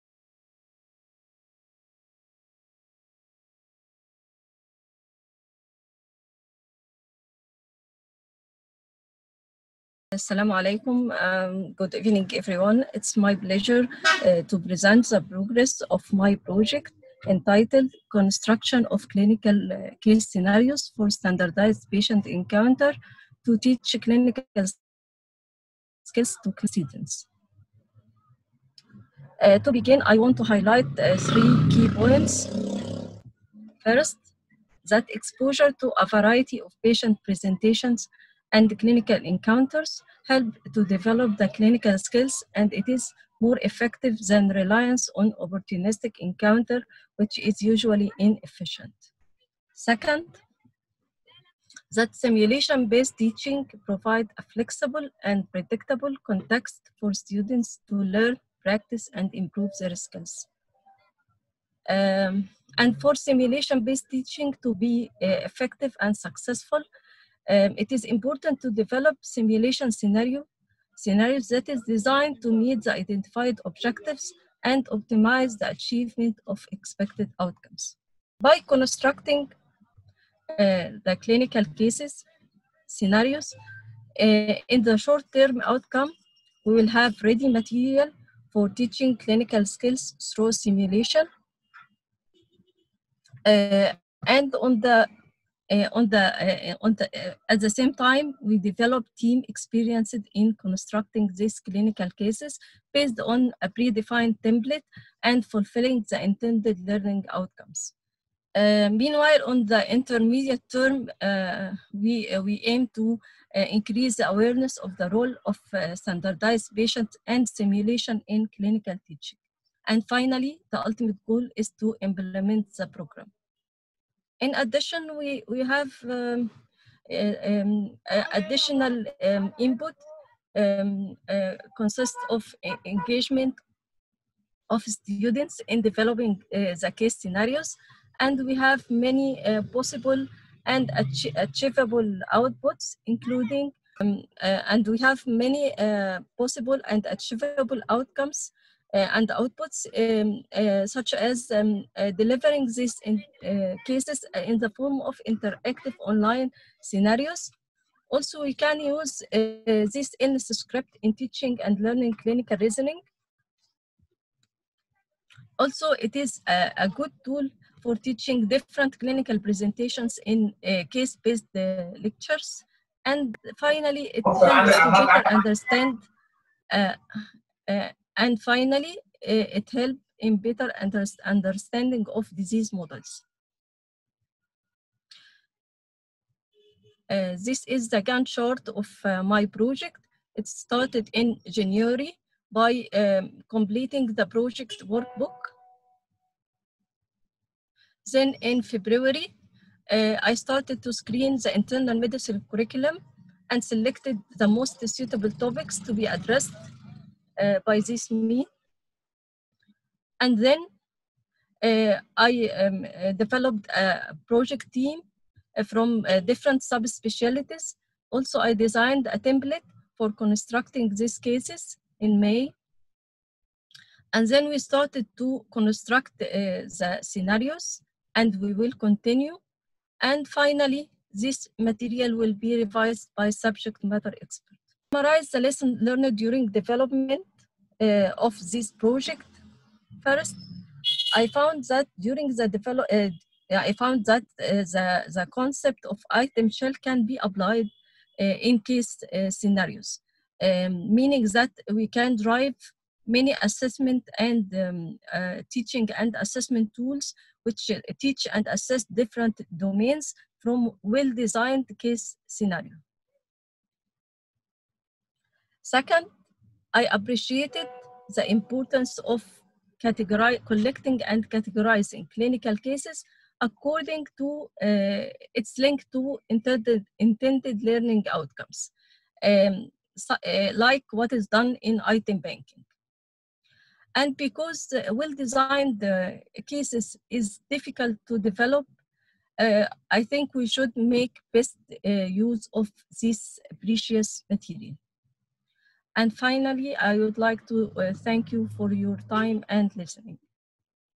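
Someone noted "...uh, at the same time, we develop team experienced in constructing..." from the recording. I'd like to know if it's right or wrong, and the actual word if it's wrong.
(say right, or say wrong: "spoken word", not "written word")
right.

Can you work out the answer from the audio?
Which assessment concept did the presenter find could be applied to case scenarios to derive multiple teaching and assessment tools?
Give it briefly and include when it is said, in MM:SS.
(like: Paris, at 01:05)
Item shell, at 04:06.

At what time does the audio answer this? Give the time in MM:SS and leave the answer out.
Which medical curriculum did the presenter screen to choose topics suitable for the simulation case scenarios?
03:21.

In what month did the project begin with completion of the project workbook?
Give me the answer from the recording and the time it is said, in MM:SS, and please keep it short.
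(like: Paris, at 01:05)
January, at 03:11.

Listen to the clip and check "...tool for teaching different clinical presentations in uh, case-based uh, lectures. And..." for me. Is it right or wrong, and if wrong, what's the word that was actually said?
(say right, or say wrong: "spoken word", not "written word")
right.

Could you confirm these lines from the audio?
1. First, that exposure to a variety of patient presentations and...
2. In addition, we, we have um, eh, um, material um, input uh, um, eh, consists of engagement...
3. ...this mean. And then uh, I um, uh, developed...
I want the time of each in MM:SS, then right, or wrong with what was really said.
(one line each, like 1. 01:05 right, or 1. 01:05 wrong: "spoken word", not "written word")
1. 00:33 right
2. 02:04 wrong: "additional", not "material"
3. 03:27 right.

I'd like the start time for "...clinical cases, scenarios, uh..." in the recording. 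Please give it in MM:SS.
01:21.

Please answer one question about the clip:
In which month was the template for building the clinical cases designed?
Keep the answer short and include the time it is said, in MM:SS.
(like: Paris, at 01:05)
May, at 03:42.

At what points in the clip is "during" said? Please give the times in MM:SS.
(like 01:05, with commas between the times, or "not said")
03:56, 04:01.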